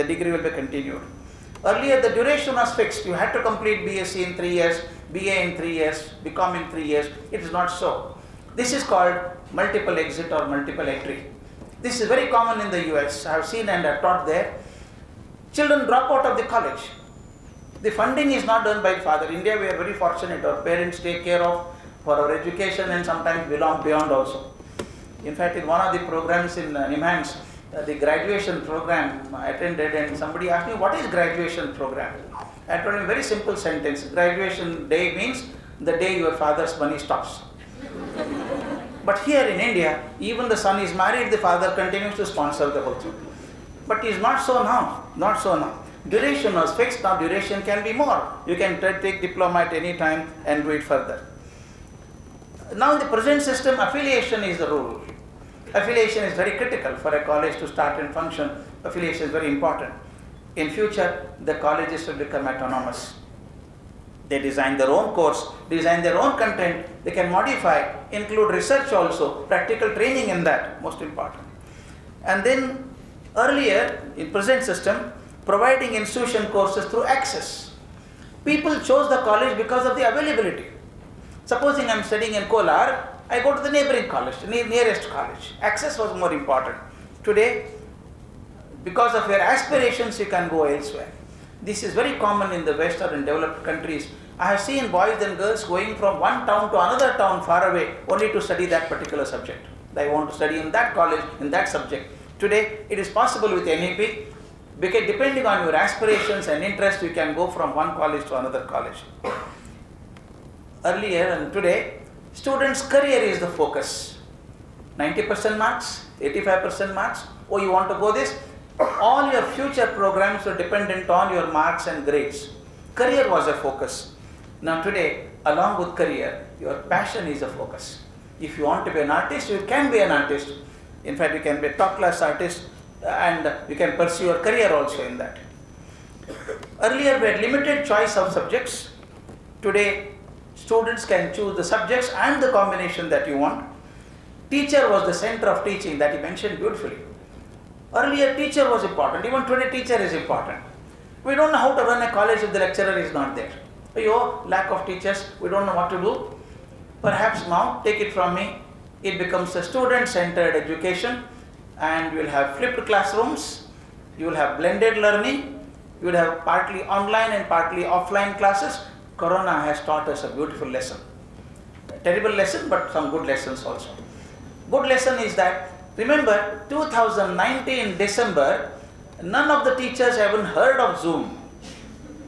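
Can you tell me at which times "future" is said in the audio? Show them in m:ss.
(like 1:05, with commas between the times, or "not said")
1:00, 1:59.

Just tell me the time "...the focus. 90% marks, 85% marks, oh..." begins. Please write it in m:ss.
1:53.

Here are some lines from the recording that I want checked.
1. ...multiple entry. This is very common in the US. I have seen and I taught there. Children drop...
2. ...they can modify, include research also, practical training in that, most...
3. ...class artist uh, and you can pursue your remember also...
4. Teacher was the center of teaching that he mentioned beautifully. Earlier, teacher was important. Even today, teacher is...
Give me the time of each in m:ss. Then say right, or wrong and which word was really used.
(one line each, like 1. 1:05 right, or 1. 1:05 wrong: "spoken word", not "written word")
1. 0:10 right
2. 1:07 right
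3. 2:11 wrong: "career", not "remember"
4. 2:24 right.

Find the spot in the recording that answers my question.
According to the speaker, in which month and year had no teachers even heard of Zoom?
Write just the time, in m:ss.
2:56.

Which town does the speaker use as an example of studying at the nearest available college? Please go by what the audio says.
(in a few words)
Kolar.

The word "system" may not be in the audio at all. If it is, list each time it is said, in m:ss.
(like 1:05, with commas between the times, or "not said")
0:53, 1:14.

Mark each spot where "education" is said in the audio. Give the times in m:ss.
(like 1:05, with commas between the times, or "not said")
0:22, 2:40.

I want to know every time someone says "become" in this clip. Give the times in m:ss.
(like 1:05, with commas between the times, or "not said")
1:02, 2:39.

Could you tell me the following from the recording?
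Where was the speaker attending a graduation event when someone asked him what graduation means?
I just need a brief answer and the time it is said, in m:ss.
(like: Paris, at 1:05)
Nimhans, at 0:26.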